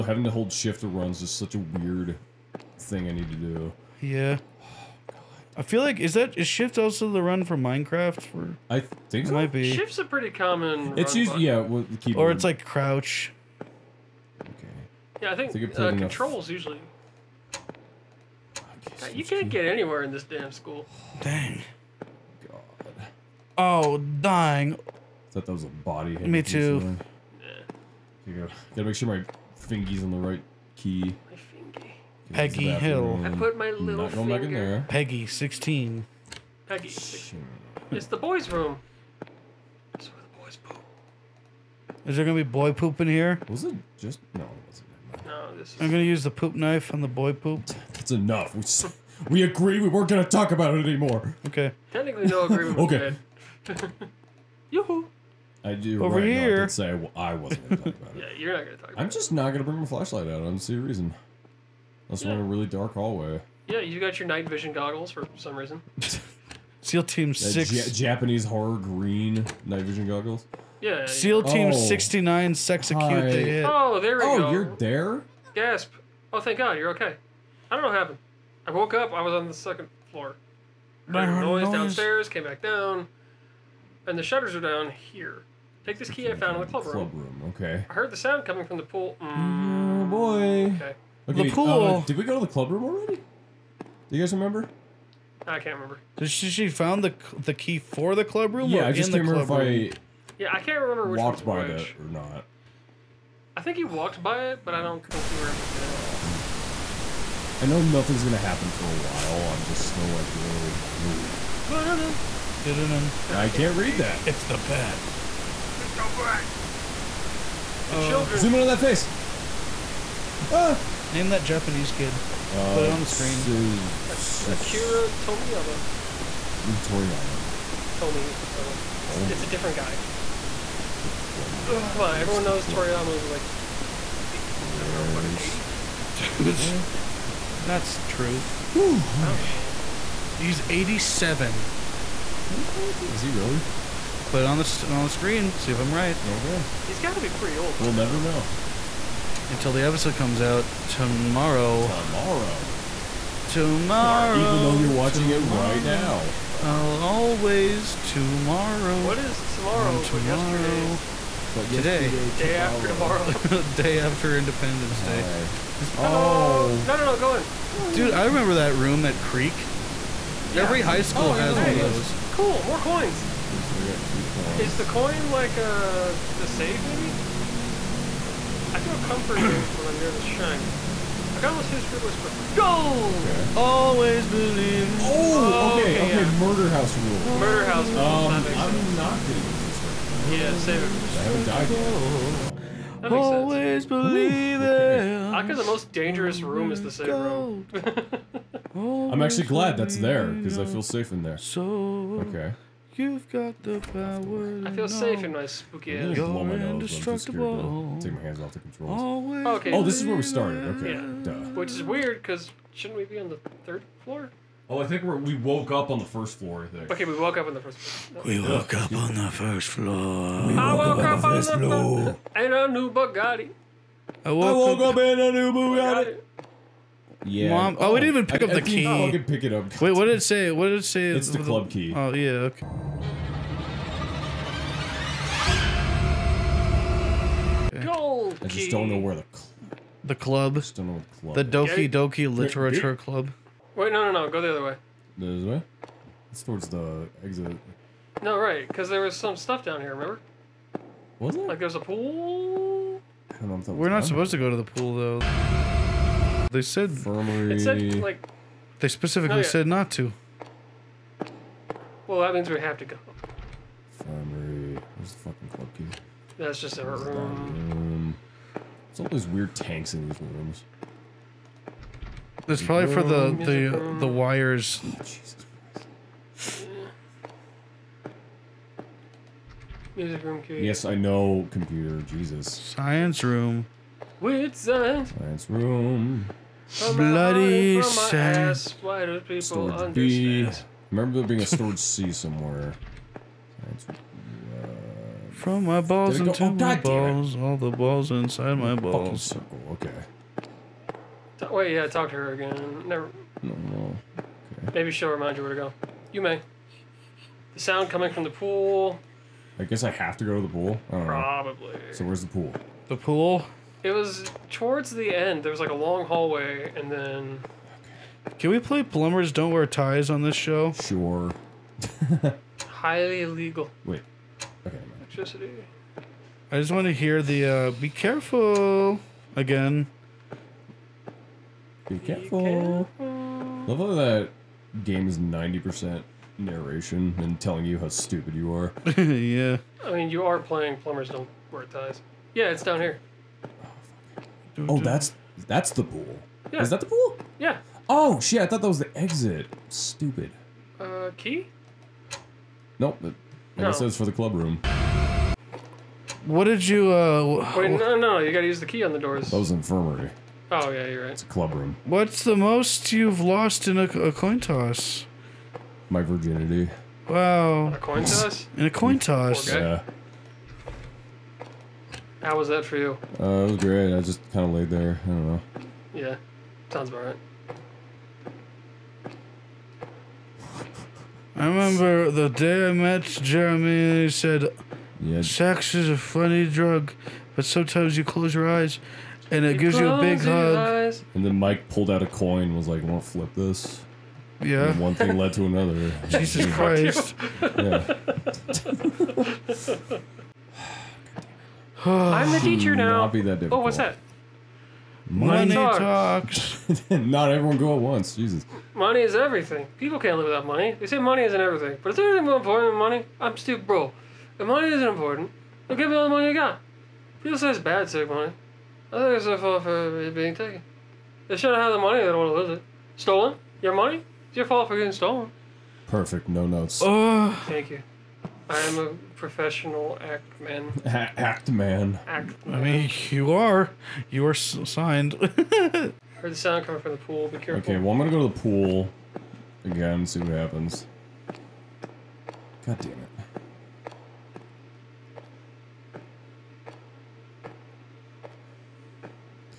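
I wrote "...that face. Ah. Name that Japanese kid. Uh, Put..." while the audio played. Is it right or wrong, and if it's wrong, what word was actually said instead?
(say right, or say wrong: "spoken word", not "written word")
right.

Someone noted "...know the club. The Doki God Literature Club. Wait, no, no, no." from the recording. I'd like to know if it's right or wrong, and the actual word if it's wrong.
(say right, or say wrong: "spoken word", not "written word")
wrong: "Doki", not "God".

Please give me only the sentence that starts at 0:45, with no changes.
I'm gonna use the poop knife on the boy pooped.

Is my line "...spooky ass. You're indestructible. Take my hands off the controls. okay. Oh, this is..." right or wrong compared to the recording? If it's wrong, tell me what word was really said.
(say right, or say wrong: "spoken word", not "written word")
right.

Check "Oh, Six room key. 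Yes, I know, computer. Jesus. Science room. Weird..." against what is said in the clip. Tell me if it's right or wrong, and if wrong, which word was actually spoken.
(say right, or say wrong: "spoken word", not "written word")
wrong: "Music", not "Six".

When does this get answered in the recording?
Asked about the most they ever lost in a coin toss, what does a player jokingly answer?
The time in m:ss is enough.
6:05.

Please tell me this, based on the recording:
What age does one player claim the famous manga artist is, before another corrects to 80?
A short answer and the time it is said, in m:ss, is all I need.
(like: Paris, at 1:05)
87, at 2:20.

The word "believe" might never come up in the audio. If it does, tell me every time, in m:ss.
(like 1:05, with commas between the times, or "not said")
3:04, 3:13.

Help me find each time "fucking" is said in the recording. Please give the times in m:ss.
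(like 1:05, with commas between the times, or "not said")
2:15, 4:25.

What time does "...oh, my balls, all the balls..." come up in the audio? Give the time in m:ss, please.
4:56.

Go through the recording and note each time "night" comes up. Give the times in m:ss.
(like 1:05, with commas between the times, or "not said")
1:04, 1:09.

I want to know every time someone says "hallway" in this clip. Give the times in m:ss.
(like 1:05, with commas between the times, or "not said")
1:02, 5:16.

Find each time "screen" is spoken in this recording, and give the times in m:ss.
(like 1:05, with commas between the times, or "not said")
2:03, 2:25.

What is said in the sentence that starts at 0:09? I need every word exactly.
might be shift's a pretty common.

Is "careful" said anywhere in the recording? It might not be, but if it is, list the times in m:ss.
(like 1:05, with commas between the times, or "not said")
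5:27, 5:31, 7:17.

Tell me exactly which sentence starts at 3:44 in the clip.
I woke, I woke up, up in a new Bugatti.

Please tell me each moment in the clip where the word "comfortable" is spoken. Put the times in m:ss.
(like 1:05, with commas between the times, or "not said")
2:58.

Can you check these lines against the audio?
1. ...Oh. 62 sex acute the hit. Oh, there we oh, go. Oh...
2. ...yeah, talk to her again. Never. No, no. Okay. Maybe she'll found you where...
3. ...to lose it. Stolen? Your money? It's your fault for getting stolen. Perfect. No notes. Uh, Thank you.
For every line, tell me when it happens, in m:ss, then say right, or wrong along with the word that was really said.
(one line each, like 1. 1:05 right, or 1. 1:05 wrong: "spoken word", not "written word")
1. 1:11 wrong: "69", not "62"
2. 5:01 wrong: "remind", not "found"
3. 7:02 right.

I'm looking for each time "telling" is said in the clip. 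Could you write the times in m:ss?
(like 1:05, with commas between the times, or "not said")
5:37.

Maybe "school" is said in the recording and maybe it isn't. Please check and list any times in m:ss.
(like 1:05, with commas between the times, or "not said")
0:20, 2:51.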